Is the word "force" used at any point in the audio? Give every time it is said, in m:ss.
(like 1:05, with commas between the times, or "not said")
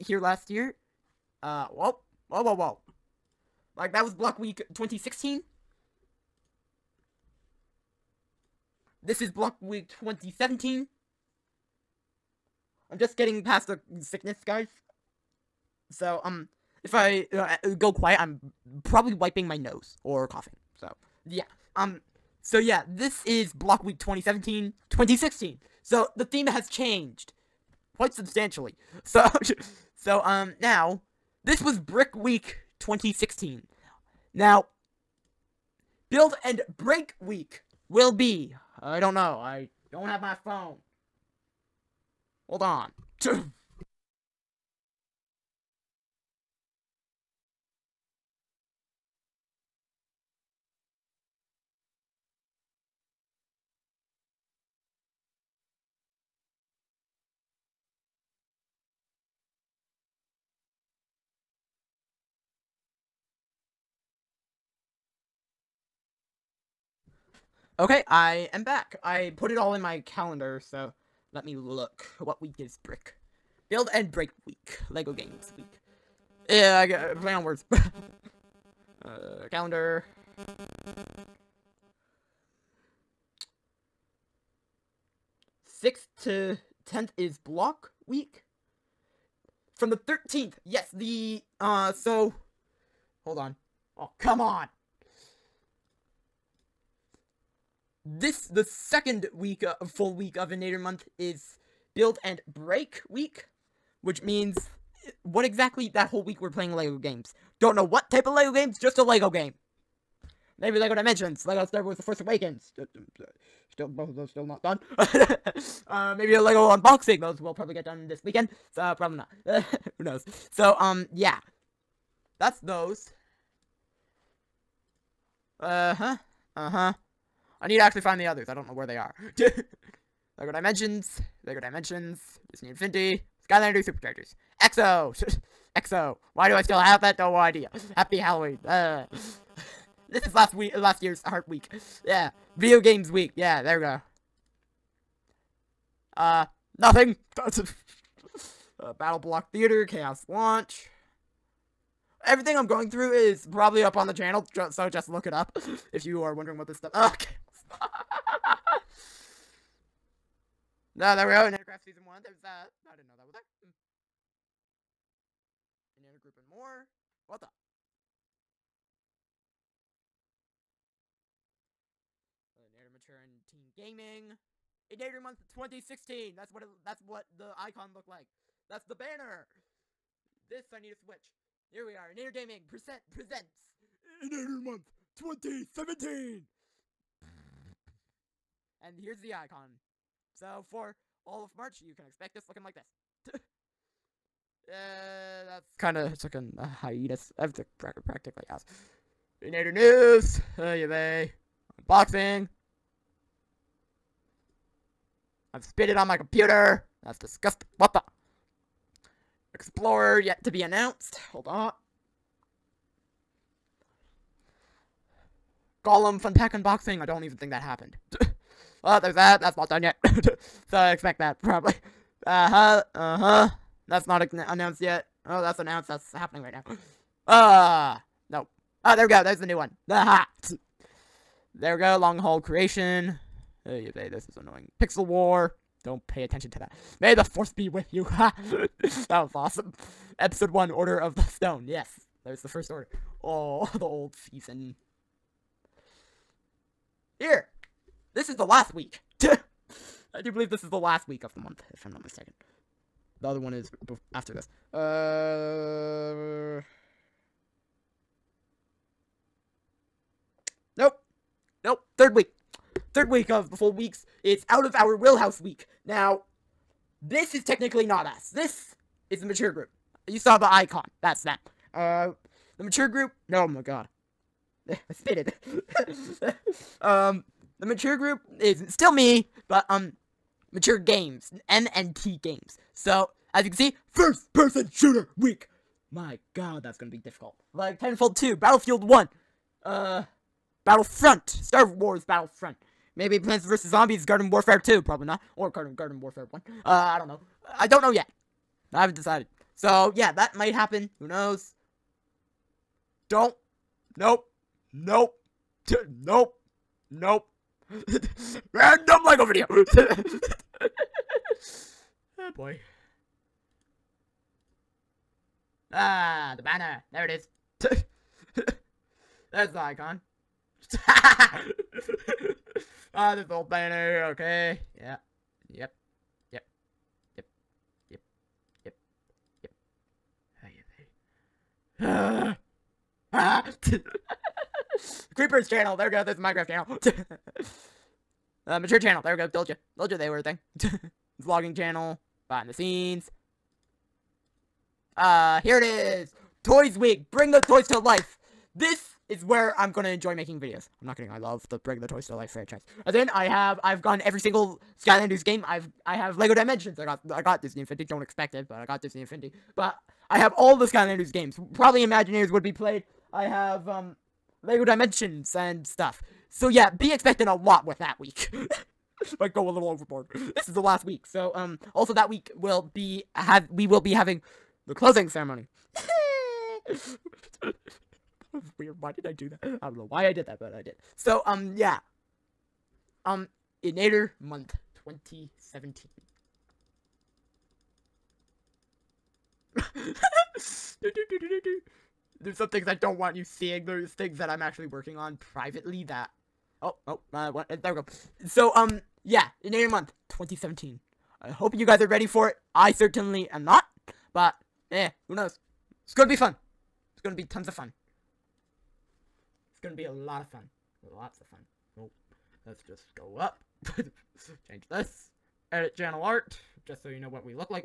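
1:52, 3:57.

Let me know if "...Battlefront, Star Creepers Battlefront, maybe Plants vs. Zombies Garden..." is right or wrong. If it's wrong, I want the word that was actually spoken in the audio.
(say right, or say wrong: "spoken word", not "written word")
wrong: "Wars", not "Creepers".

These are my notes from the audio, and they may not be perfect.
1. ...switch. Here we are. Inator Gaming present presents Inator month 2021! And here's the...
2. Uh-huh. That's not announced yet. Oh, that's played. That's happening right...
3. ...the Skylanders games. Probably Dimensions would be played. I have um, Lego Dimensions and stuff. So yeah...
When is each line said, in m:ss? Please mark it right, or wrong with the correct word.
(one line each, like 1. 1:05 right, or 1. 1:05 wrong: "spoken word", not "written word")
1. 3:00 wrong: "2017", not "2021"
2. 3:42 wrong: "announced", not "played"
3. 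6:00 wrong: "Imaginators", not "Dimensions".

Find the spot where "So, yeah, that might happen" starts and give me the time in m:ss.
4:59.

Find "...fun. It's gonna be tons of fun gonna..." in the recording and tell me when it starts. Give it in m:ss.
6:46.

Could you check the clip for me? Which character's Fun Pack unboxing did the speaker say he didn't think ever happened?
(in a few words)
Gollum.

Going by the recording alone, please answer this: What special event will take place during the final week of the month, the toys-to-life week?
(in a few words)
Closing ceremony.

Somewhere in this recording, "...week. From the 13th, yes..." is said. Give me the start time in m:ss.
1:28.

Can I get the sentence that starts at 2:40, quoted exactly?
no, there we go, in Aircraft Season 1, there's, uh, I didn't know that was there.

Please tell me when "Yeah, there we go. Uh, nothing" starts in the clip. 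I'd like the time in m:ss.
2:23.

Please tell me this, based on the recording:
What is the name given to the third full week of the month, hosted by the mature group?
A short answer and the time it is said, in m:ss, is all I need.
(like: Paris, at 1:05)
Out of our wheelhouse week, at 4:24.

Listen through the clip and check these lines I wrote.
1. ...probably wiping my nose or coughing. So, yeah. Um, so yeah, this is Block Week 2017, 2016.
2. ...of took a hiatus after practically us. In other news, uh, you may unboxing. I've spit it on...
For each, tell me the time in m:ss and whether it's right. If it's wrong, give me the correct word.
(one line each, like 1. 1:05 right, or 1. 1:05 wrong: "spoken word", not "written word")
1. 0:18 right
2. 3:15 right.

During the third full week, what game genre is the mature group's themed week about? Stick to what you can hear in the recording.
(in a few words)
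First person shooter.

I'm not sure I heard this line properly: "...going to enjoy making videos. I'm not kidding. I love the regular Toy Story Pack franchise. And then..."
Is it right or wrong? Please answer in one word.
wrong.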